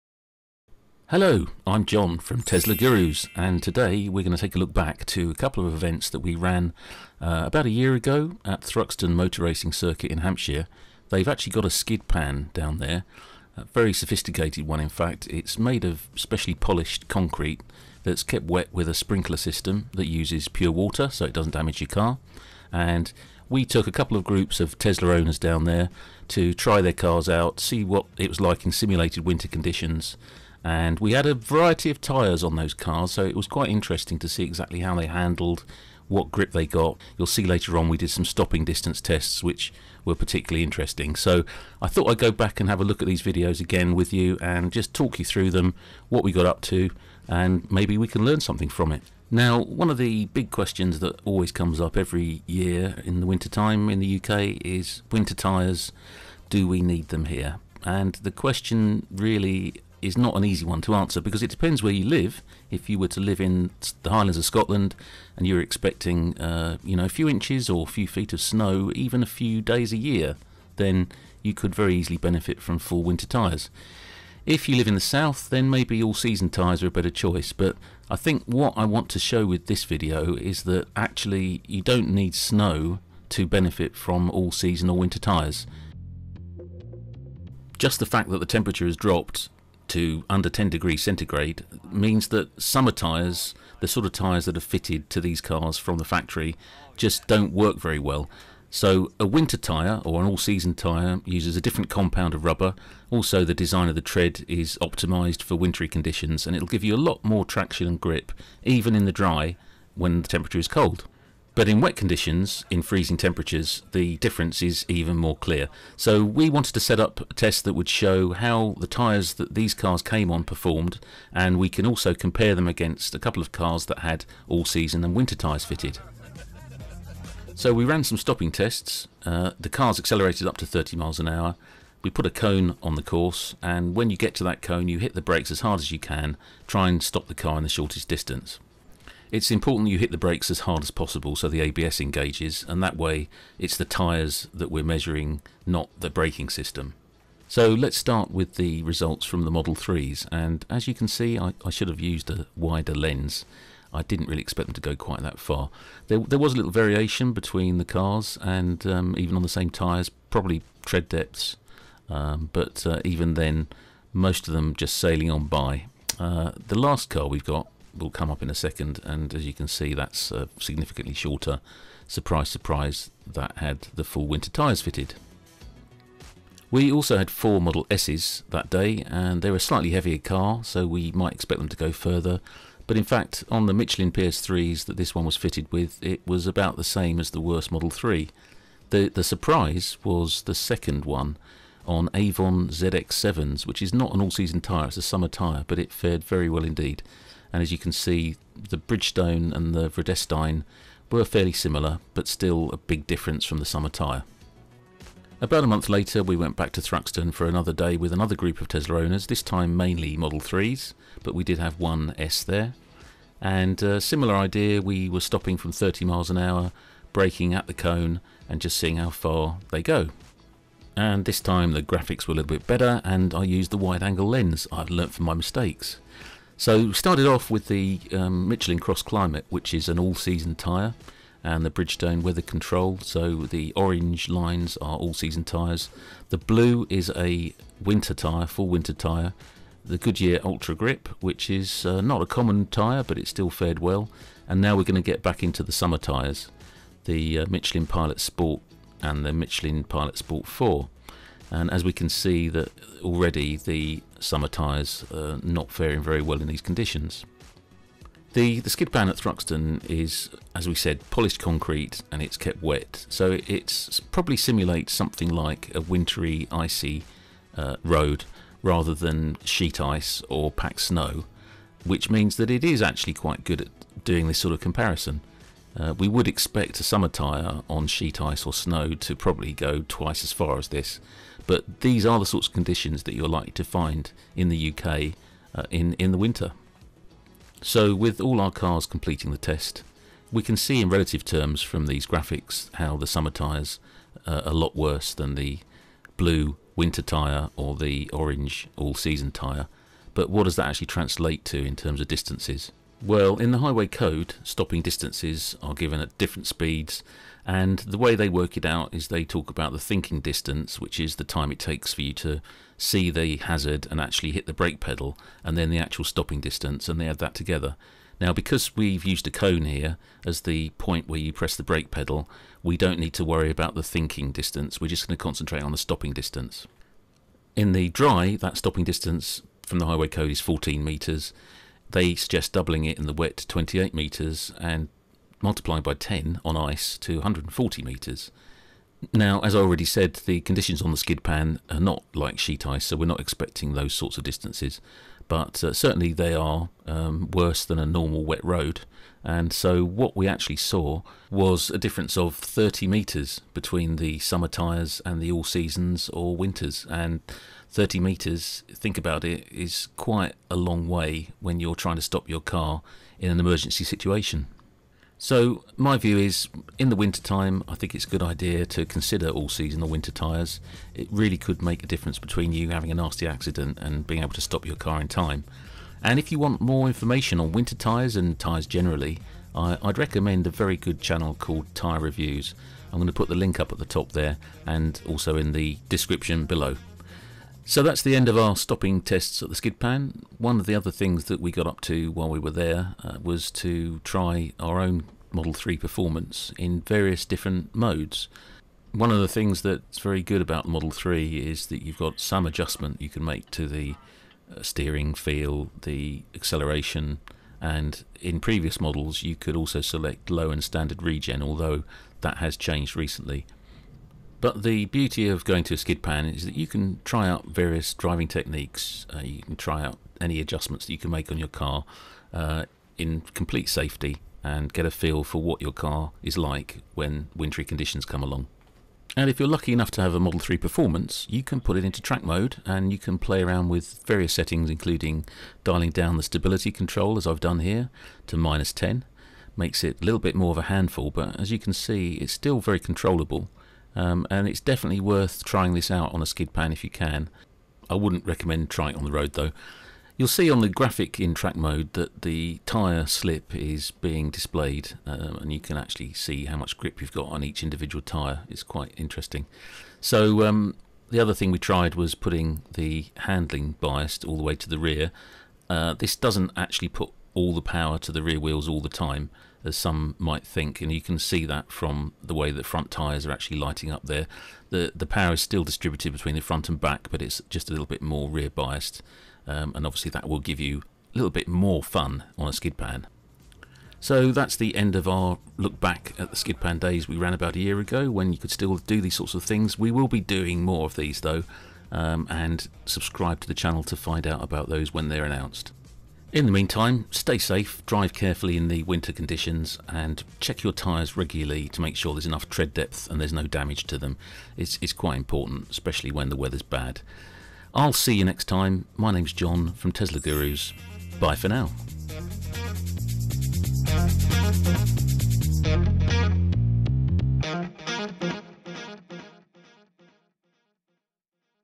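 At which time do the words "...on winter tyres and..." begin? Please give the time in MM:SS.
06:17.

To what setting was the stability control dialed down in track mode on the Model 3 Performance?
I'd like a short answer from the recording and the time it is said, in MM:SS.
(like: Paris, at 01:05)
-10, at 07:18.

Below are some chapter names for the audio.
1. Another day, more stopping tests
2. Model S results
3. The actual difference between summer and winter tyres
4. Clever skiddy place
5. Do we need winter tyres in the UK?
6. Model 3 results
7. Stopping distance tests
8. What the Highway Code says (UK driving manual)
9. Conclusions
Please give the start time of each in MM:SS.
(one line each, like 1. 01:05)
1. 03:25
2. 02:58
3. 05:50
4. 00:10
5. 00:50
6. 02:25
7. 02:07
8. 04:50
9. 06:00.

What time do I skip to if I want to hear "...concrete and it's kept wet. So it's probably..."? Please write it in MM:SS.
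04:21.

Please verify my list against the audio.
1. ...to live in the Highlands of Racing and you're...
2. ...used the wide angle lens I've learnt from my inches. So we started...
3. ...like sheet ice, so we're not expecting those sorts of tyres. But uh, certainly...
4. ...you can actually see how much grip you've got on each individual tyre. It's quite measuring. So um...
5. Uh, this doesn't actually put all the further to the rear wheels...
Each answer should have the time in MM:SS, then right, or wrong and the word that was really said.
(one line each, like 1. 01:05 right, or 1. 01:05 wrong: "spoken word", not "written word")
1. 01:03 wrong: "Scotland", not "Racing"
2. 03:43 wrong: "mistakes", not "inches"
3. 05:42 wrong: "distances", not "tyres"
4. 07:35 wrong: "interesting", not "measuring"
5. 07:45 wrong: "power", not "further".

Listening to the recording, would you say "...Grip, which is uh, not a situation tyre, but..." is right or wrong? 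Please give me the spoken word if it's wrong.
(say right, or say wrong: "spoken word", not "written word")
wrong: "common", not "situation".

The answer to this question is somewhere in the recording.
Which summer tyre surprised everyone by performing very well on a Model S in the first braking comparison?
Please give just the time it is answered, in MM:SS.
03:12.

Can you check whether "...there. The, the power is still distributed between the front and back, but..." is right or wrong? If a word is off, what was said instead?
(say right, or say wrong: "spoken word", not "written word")
right.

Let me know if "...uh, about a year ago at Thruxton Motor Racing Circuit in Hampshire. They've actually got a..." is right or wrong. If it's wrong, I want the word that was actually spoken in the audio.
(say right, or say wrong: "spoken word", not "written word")
right.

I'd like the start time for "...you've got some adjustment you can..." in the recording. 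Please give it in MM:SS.
06:41.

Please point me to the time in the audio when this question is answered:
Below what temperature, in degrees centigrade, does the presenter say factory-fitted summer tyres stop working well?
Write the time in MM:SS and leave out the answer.
01:30.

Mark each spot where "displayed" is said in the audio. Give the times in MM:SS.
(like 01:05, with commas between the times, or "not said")
07:34.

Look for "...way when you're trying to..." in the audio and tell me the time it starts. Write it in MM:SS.
06:00.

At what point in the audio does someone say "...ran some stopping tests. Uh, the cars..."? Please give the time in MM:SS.
02:07.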